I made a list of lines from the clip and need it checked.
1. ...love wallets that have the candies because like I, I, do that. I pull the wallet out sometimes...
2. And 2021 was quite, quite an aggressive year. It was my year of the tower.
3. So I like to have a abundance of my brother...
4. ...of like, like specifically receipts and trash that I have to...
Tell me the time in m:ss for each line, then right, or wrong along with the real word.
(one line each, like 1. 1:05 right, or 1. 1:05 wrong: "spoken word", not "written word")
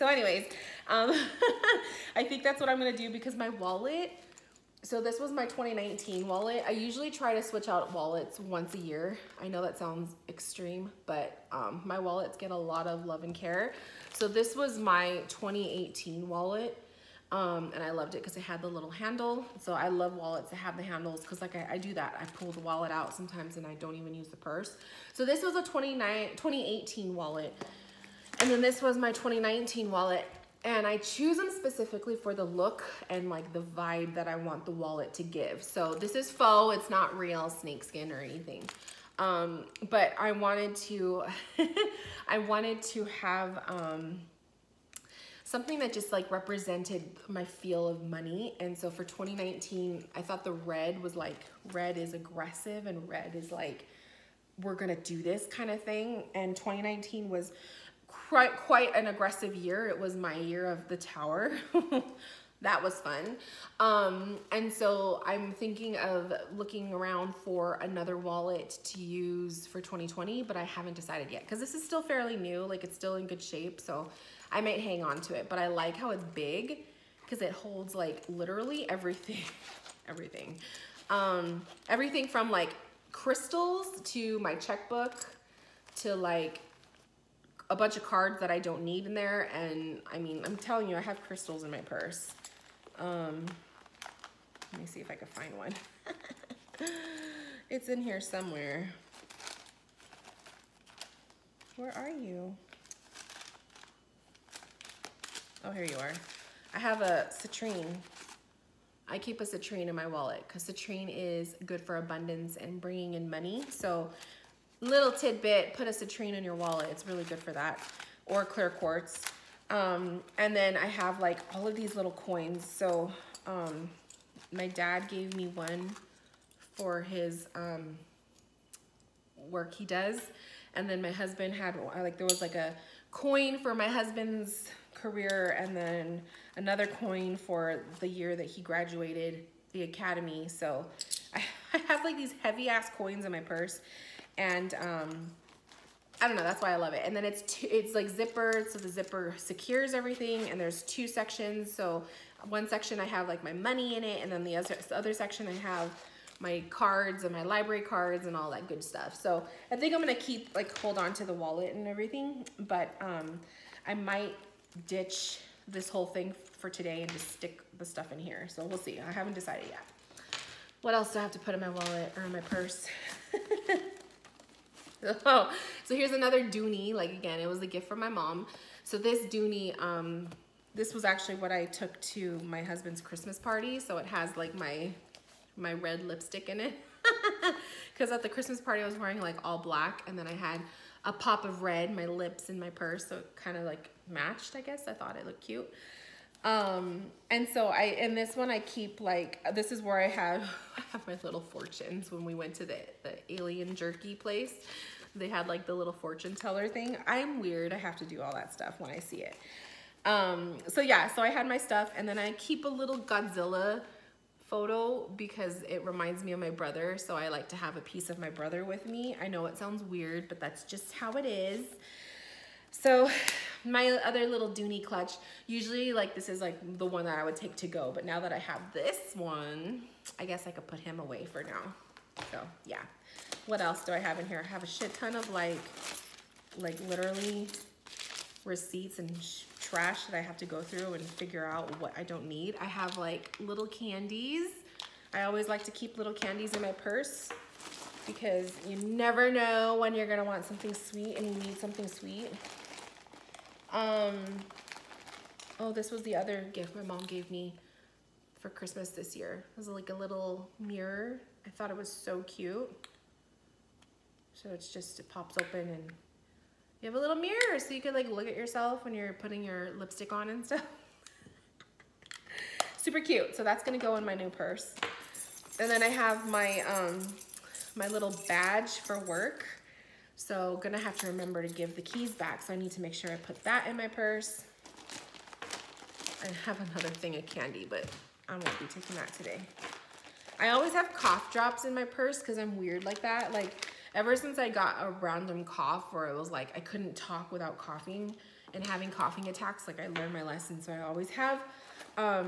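1. 0:19 wrong: "handles", not "candies"
2. 0:56 wrong: "2019", not "2021"
3. 3:36 wrong: "piece", not "abundance"
4. 3:55 wrong: "literally", not "specifically".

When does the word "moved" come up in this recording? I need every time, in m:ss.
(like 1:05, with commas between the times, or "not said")
not said.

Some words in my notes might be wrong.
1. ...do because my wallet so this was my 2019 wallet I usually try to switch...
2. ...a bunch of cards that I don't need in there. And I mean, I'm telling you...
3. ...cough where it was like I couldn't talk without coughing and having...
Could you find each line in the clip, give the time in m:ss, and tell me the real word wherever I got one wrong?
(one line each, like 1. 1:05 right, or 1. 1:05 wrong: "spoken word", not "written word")
1. 0:02 right
2. 1:27 right
3. 4:55 right.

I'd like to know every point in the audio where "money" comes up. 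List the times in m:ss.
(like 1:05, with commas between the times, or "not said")
0:48, 1:53, 2:33.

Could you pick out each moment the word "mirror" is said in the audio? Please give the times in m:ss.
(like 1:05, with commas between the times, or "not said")
4:20, 4:27.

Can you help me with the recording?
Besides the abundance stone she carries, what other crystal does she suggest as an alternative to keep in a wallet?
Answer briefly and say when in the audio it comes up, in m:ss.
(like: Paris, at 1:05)
clear quartz, at 1:58.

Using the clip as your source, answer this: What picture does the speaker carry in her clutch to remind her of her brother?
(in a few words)
Godzilla photo.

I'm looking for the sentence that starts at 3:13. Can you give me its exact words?
So it kind of like matched, I guess.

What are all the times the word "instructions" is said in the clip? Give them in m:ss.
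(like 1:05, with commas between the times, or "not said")
not said.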